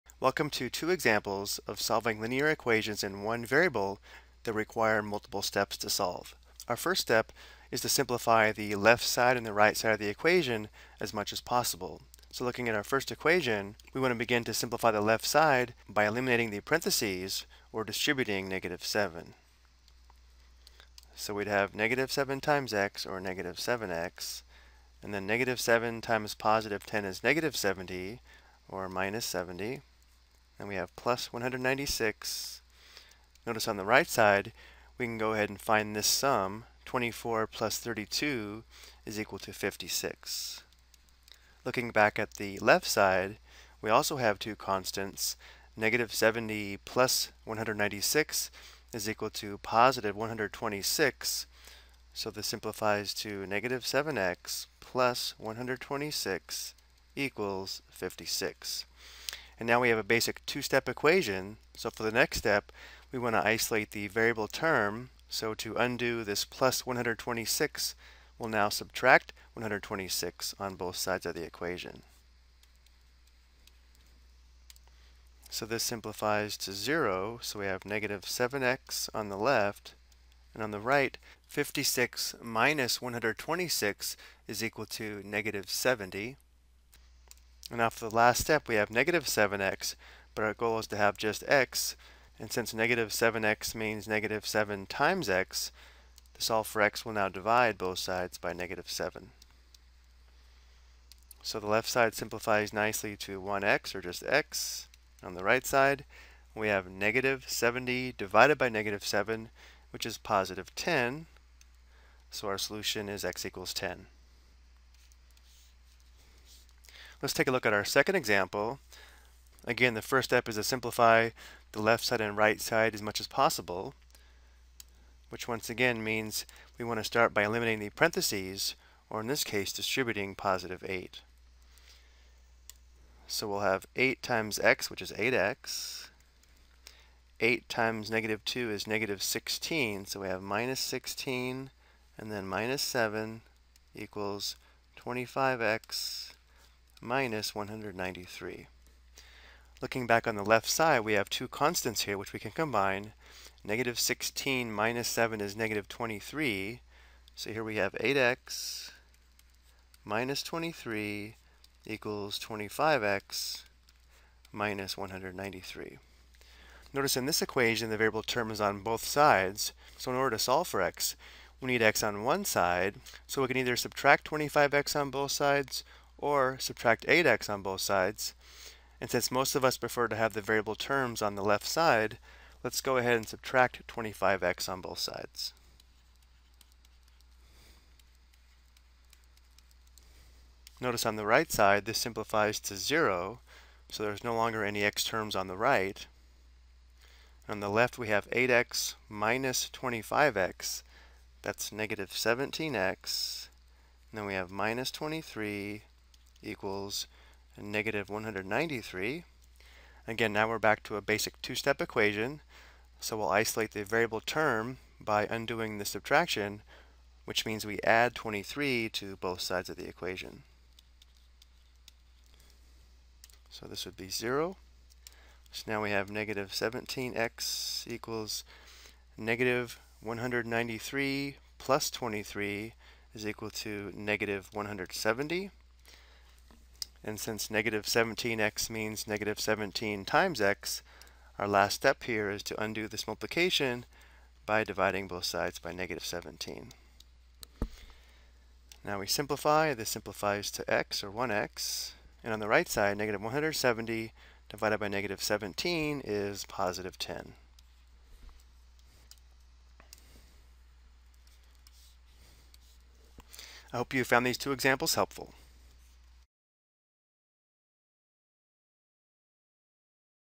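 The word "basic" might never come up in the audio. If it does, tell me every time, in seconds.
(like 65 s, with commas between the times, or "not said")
60 s, 211 s.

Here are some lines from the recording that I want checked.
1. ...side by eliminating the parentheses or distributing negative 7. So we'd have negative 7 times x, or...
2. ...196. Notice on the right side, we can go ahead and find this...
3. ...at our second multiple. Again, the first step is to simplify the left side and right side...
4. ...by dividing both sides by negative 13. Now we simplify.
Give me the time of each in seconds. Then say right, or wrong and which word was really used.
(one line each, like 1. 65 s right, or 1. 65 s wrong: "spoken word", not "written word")
1. 15 s right
2. 31 s right
3. 117 s wrong: "example", not "multiple"
4. 244 s wrong: "17", not "13".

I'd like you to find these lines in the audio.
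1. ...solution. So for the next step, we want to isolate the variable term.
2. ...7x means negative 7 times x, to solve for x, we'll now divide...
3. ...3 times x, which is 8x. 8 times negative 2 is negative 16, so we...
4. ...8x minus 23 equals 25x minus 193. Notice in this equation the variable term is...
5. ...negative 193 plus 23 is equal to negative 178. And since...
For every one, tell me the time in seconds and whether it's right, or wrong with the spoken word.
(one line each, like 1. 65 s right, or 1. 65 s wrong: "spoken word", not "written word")
1. 60 s wrong: "equation", not "solution"
2. 93 s right
3. 133 s wrong: "8", not "3"
4. 157 s right
5. 229 s wrong: "170", not "178".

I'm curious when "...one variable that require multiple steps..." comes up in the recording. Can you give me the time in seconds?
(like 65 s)
3 s.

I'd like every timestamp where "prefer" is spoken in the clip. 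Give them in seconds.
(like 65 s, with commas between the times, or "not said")
179 s.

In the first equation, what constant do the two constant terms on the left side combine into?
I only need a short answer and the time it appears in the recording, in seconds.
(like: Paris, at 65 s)
126, at 49 s.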